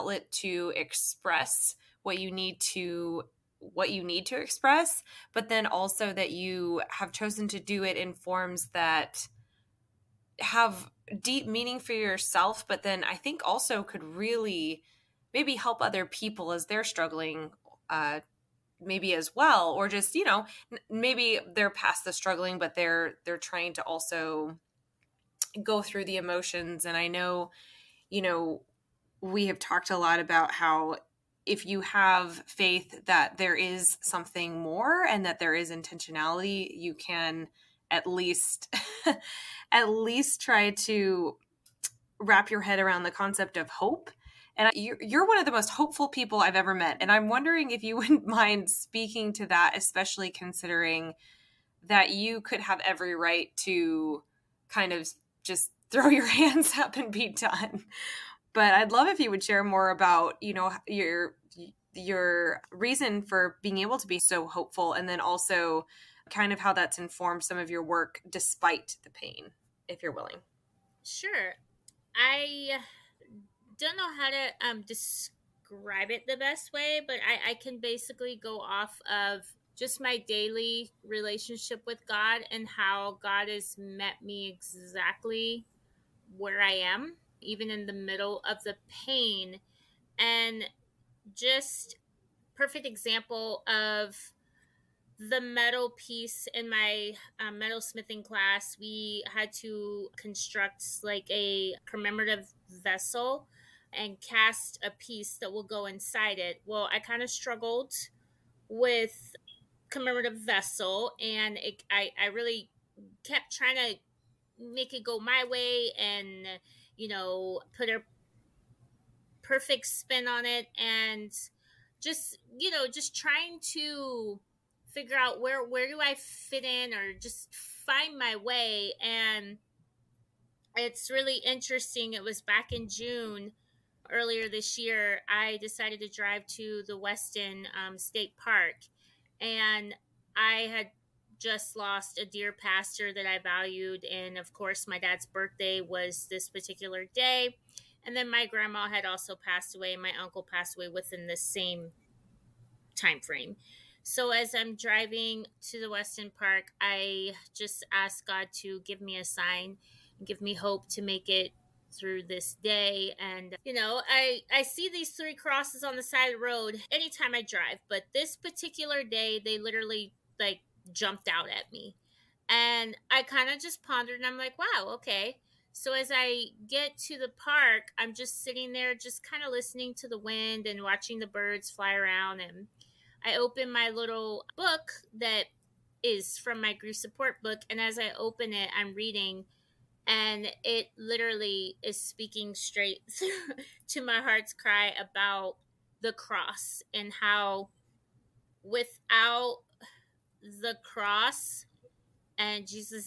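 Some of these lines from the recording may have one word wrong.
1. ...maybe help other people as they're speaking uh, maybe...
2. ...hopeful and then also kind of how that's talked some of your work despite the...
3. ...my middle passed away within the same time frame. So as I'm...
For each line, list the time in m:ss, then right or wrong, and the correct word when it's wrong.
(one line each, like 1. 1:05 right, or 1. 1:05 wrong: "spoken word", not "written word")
1. 0:15 wrong: "struggling", not "speaking"
2. 1:04 wrong: "informed", not "talked"
3. 2:30 wrong: "uncle", not "middle".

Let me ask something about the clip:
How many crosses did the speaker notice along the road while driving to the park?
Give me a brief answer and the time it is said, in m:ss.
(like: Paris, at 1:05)
3, at 2:45.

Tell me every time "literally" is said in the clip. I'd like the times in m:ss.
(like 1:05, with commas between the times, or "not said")
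2:49, 3:10.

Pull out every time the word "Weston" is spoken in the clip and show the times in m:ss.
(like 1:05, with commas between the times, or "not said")
2:16, 2:35.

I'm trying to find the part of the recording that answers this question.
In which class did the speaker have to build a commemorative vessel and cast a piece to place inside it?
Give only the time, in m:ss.
1:37.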